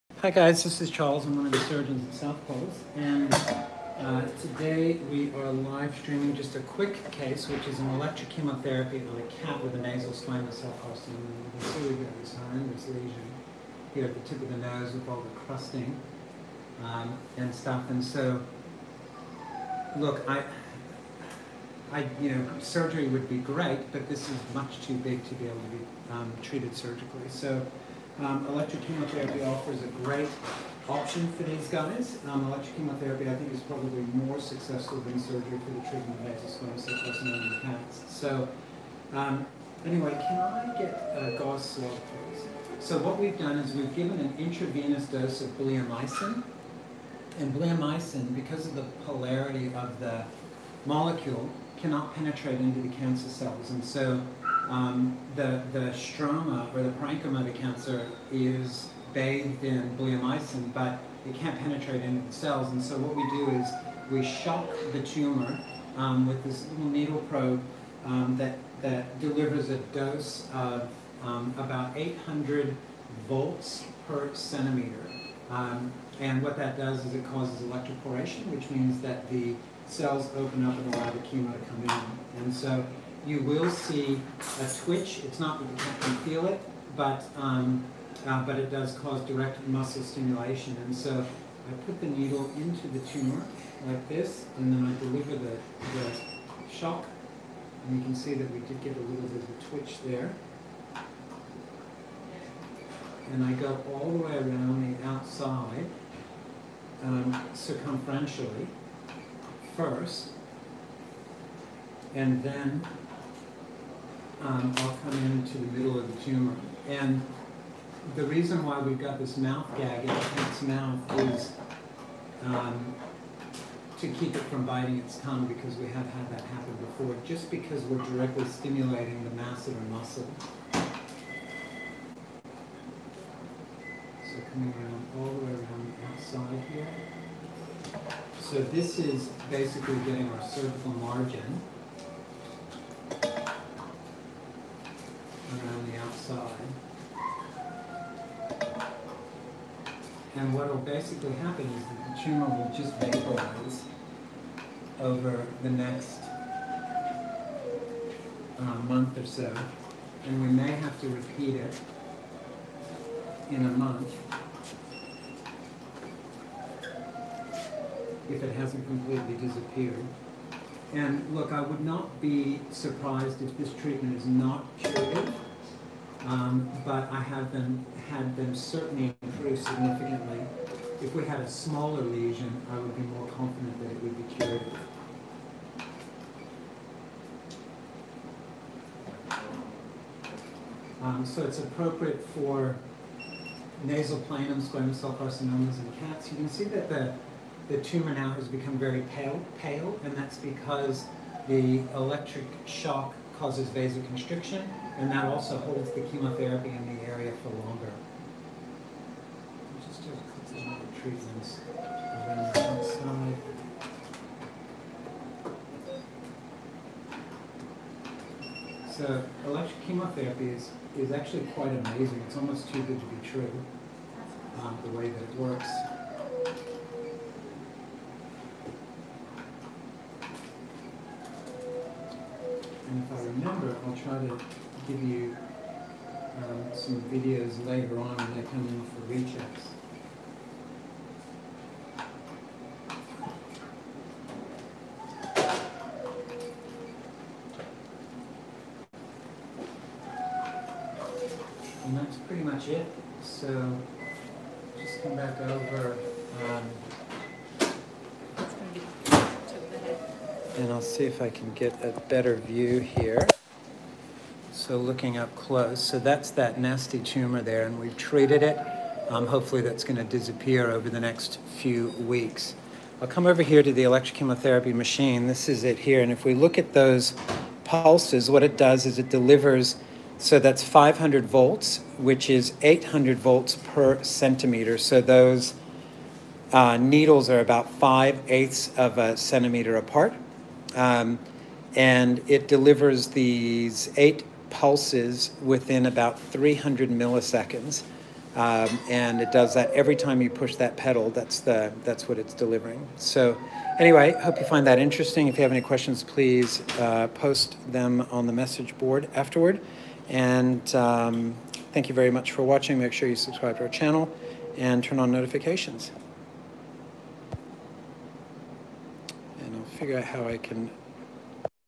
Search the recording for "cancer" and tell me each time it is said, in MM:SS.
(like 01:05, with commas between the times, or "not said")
00:52, 00:57.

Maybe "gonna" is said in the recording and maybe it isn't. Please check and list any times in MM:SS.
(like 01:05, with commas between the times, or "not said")
04:29.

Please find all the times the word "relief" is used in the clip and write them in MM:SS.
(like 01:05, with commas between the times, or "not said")
not said.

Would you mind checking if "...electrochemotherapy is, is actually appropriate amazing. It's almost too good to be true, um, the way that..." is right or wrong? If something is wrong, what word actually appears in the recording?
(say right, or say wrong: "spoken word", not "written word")
wrong: "quite", not "appropriate".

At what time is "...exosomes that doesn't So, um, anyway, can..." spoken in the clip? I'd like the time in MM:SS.
00:36.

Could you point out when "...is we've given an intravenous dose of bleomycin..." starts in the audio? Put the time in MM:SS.
00:43.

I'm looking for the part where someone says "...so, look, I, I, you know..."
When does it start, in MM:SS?
00:18.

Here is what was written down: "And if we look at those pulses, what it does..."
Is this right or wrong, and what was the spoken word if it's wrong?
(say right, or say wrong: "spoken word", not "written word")
right.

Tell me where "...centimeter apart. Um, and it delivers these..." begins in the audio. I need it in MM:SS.
04:49.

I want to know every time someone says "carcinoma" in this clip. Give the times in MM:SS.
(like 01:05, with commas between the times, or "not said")
00:10, 03:15.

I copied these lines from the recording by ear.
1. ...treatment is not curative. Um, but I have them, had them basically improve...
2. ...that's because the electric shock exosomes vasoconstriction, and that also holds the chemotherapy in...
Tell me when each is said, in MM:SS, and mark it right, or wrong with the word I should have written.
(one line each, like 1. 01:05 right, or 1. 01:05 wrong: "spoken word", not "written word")
1. 02:53 wrong: "certainly", not "basically"
2. 03:20 wrong: "causes", not "exosomes".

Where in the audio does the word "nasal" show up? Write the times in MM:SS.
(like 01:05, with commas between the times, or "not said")
00:09, 03:13.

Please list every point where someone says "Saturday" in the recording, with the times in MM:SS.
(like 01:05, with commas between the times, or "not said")
not said.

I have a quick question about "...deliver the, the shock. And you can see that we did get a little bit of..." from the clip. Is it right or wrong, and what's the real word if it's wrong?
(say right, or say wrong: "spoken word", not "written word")
right.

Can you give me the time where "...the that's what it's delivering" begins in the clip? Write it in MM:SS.
05:01.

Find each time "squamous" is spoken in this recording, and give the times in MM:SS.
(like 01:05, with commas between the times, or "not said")
00:10, 03:14.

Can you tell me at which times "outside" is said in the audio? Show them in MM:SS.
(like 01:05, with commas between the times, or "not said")
01:45, 02:16.